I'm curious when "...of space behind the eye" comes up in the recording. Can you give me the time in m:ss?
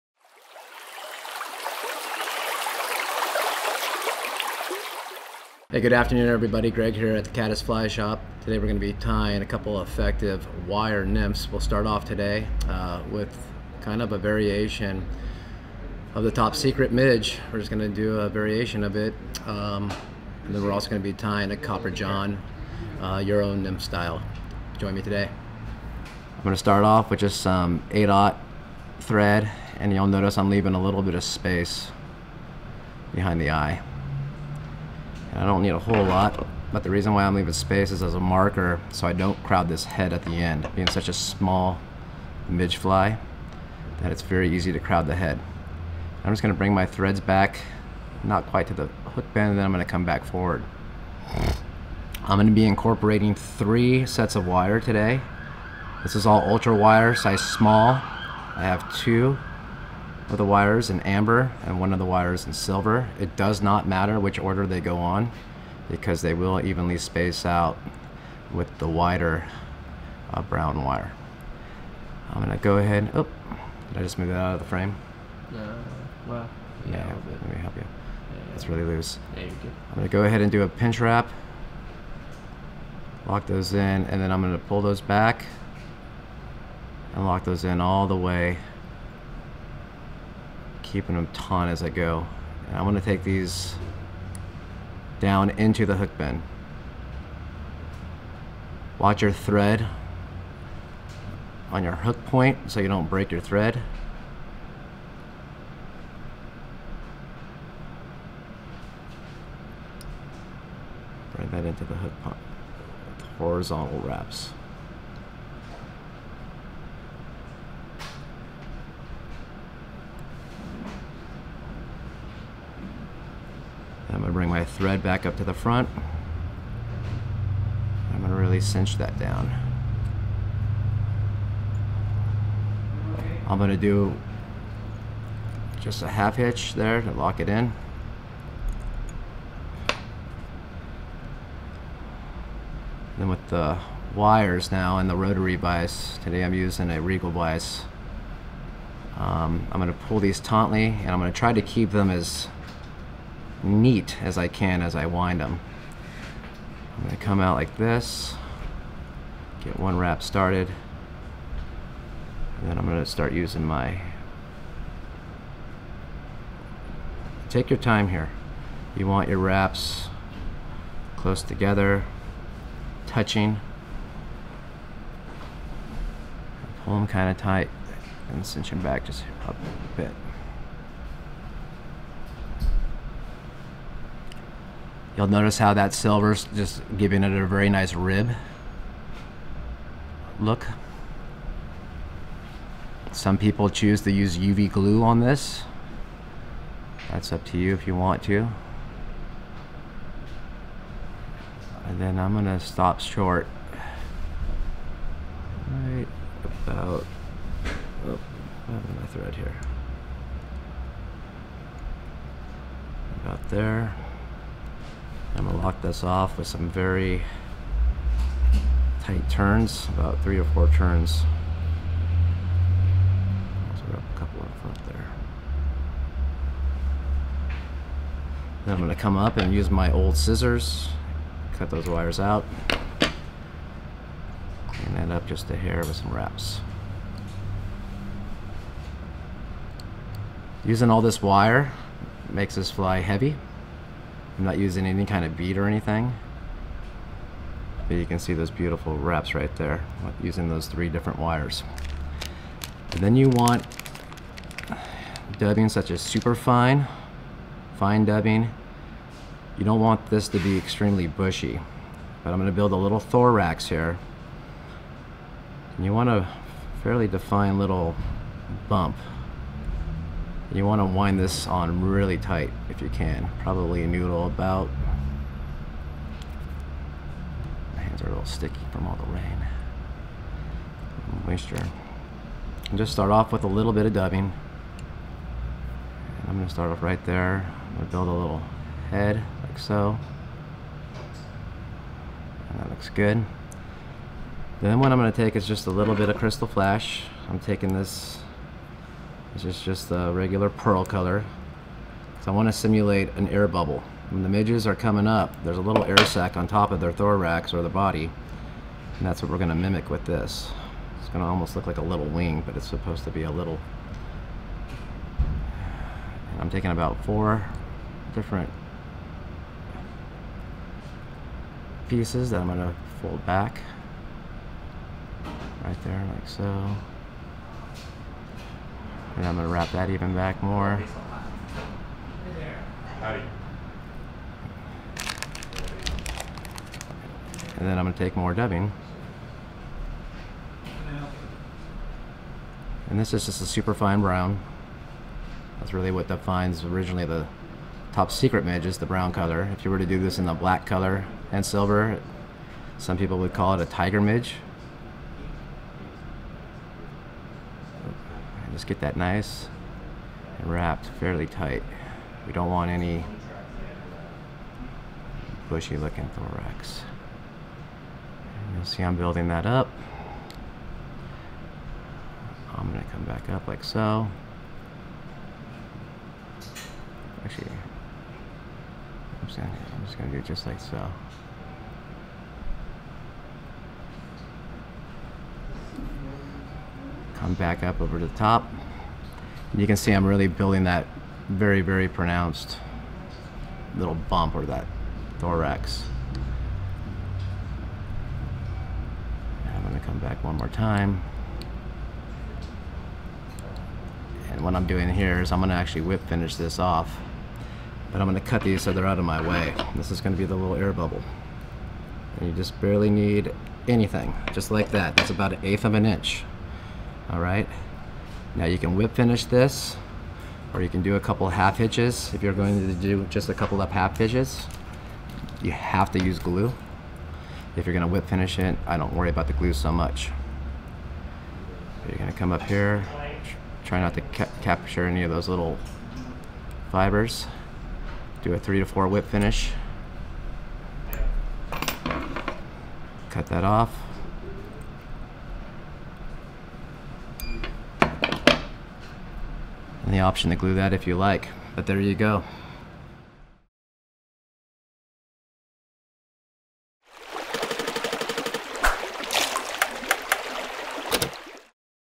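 0:31.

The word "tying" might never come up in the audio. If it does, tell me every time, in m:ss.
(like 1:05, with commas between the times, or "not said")
0:08, 0:21.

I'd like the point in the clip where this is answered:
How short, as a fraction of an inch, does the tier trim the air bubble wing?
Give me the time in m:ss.
6:55.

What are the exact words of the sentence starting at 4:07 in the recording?
But you can see those beautiful wraps right there using those three different wires.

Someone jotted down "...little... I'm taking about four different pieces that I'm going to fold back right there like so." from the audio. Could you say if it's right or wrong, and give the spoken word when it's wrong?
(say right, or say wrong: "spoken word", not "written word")
right.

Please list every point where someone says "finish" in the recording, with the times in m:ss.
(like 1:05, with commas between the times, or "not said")
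6:46, 6:58, 7:08, 7:19.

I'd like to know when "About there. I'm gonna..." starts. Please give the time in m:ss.
3:33.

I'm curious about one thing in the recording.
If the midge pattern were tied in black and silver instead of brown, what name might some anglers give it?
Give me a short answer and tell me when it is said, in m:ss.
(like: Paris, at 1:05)
tiger midge, at 5:53.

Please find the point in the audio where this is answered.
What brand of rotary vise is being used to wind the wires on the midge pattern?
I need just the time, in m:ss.
2:27.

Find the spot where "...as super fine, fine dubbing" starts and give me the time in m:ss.
4:15.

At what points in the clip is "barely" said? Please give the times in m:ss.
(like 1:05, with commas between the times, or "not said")
6:52.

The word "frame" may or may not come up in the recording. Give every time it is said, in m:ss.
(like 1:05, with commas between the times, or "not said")
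1:14.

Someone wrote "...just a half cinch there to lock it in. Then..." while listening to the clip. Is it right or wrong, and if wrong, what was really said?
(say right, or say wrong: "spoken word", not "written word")
wrong: "hitch", not "cinch".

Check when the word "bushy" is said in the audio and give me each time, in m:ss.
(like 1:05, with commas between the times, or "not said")
4:21, 6:05.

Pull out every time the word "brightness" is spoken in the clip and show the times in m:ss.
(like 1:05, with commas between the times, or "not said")
not said.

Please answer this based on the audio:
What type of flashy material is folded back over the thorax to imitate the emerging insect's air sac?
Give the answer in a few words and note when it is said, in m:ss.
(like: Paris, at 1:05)
crystal flash, at 4:56.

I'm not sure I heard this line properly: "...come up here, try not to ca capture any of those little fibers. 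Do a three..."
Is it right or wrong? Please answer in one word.
right.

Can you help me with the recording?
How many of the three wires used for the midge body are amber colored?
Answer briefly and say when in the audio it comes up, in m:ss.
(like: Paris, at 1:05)
2, at 0:58.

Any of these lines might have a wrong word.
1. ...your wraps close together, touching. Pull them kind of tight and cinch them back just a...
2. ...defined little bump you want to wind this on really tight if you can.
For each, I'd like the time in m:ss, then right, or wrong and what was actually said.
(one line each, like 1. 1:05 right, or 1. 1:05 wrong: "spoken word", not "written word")
1. 2:49 right
2. 4:27 right.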